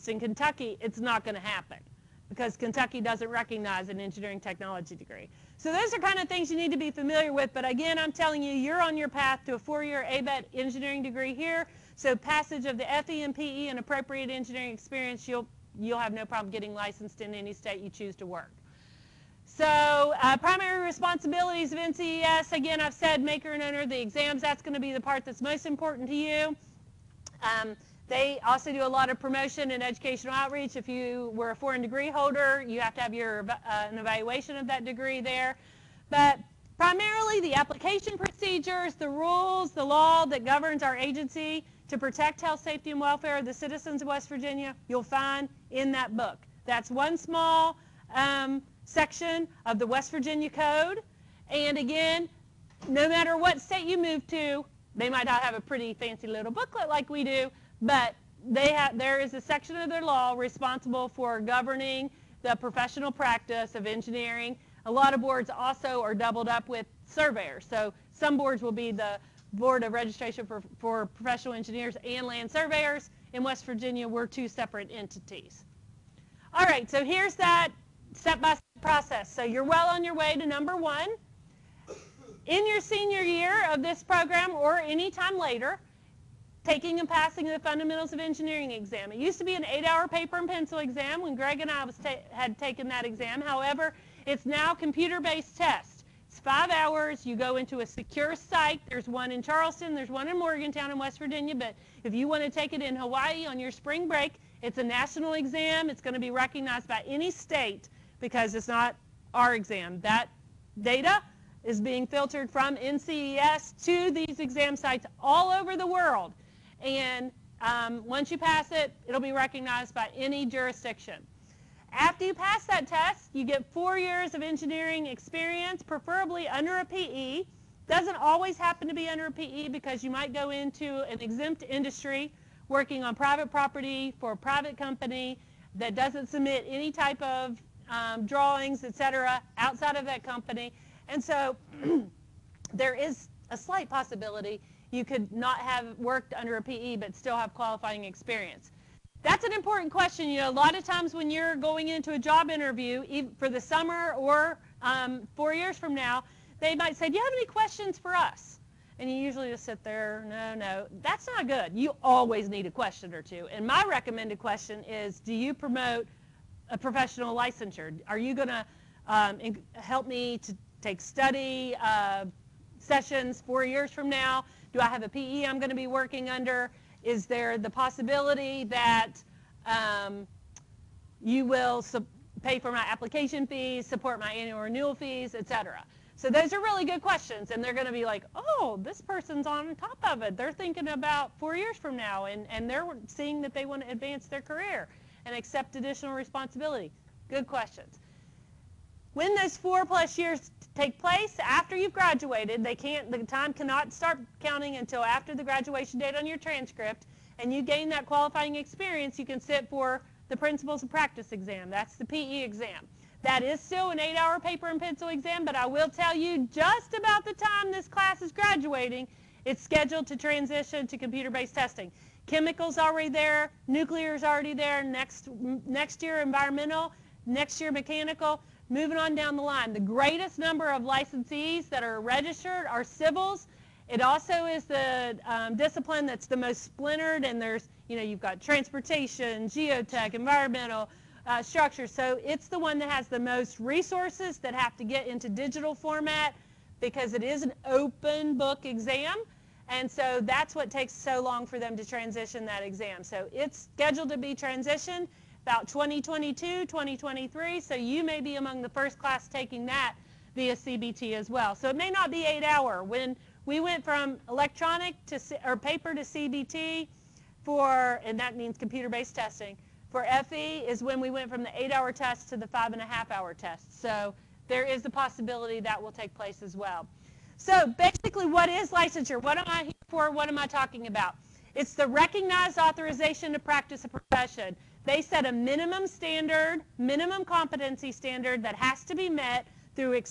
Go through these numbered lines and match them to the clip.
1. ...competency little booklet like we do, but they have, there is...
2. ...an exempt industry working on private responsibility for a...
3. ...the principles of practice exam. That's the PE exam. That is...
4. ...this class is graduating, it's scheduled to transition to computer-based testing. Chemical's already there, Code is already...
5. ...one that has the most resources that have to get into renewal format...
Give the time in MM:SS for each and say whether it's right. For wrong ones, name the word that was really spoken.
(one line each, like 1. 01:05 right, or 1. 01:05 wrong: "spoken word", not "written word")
1. 00:55 wrong: "fancy", not "competency"
2. 02:11 wrong: "property", not "responsibility"
3. 03:30 right
4. 03:37 wrong: "Nuclear", not "Code"
5. 04:02 wrong: "digital", not "renewal".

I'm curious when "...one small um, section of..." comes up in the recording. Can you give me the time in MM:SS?
00:46.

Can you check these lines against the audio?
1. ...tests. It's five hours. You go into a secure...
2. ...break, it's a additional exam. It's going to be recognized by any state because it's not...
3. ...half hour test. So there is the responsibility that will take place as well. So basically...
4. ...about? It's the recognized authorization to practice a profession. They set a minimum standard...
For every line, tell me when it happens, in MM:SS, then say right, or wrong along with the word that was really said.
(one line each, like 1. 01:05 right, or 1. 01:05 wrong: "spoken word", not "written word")
1. 01:35 right
2. 01:44 wrong: "national", not "additional"
3. 04:32 wrong: "possibility", not "responsibility"
4. 04:40 right.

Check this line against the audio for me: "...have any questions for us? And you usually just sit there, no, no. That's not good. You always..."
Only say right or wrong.
right.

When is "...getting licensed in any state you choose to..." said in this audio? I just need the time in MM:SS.
00:16.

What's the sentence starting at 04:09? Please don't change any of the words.
And so that's what takes so long for them to transition that exam.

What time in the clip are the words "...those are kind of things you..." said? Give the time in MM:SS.
00:05.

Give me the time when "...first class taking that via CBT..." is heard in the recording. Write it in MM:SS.
04:18.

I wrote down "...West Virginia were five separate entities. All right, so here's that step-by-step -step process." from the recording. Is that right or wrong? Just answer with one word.
wrong.